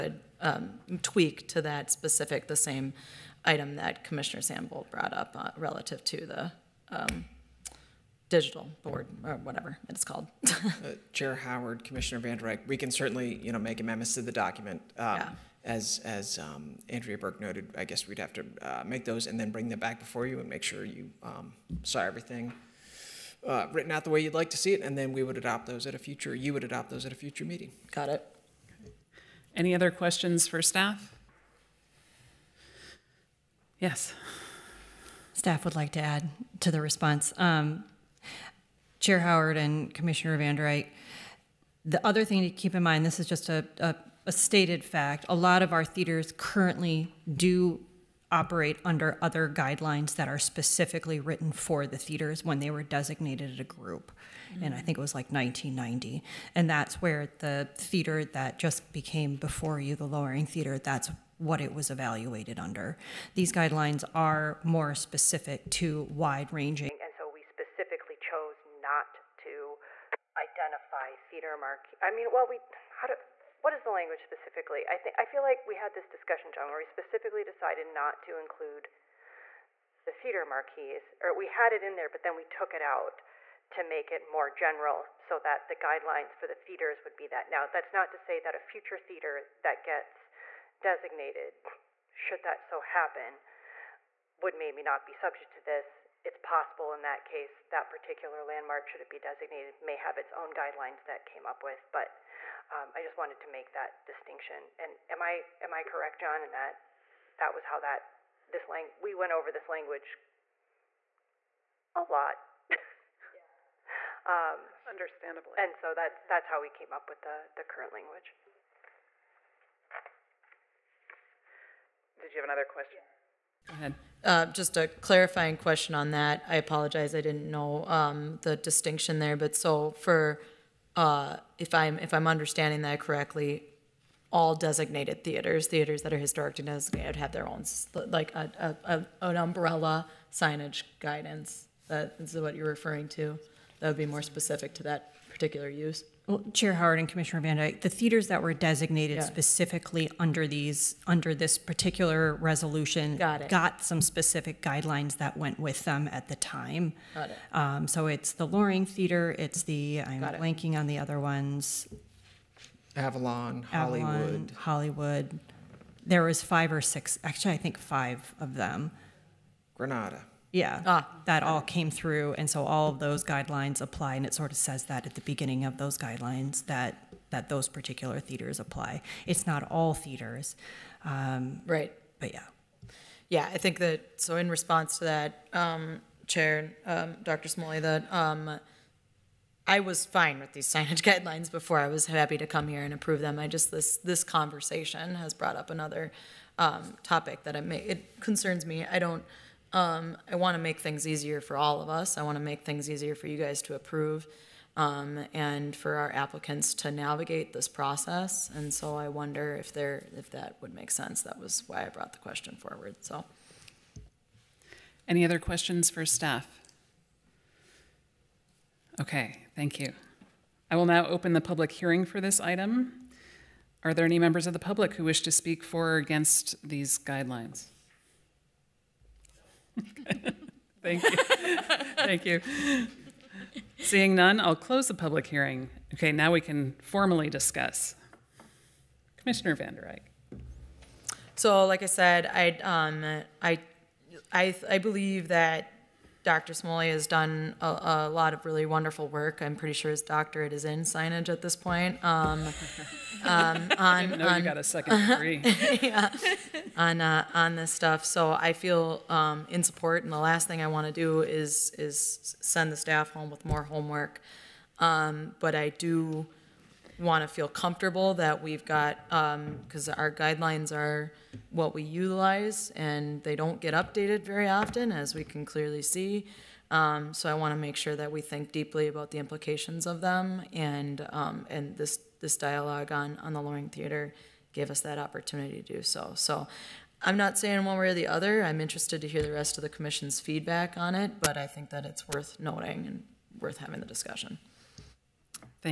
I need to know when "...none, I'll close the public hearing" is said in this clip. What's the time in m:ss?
3:54.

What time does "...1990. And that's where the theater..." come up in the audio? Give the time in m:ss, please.
0:55.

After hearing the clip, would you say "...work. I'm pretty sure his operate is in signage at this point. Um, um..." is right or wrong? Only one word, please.
wrong.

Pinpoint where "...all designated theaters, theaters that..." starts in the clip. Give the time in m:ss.
2:14.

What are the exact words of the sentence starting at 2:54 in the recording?
And it sort of says that at the beginning of those guidelines that, that those particular theaters apply.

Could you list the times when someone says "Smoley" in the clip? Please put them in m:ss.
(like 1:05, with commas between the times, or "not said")
3:07, 4:06.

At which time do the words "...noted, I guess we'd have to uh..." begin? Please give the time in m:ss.
0:17.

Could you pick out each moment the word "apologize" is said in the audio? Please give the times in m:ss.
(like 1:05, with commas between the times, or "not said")
2:06.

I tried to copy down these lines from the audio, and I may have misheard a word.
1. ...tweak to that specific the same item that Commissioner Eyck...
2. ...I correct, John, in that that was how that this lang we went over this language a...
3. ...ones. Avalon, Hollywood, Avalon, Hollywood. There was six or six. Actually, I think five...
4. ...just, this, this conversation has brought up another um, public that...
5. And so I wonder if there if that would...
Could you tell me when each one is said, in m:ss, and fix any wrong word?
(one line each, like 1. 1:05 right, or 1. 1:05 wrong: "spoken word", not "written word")
1. 0:01 wrong: "Sandbolt", not "Eyck"
2. 1:45 right
3. 2:41 wrong: "five", not "six"
4. 3:13 wrong: "topic", not "public"
5. 3:28 right.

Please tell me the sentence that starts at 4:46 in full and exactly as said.
So I'm not saying one way or the other.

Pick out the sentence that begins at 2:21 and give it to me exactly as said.
That is what you're referring to.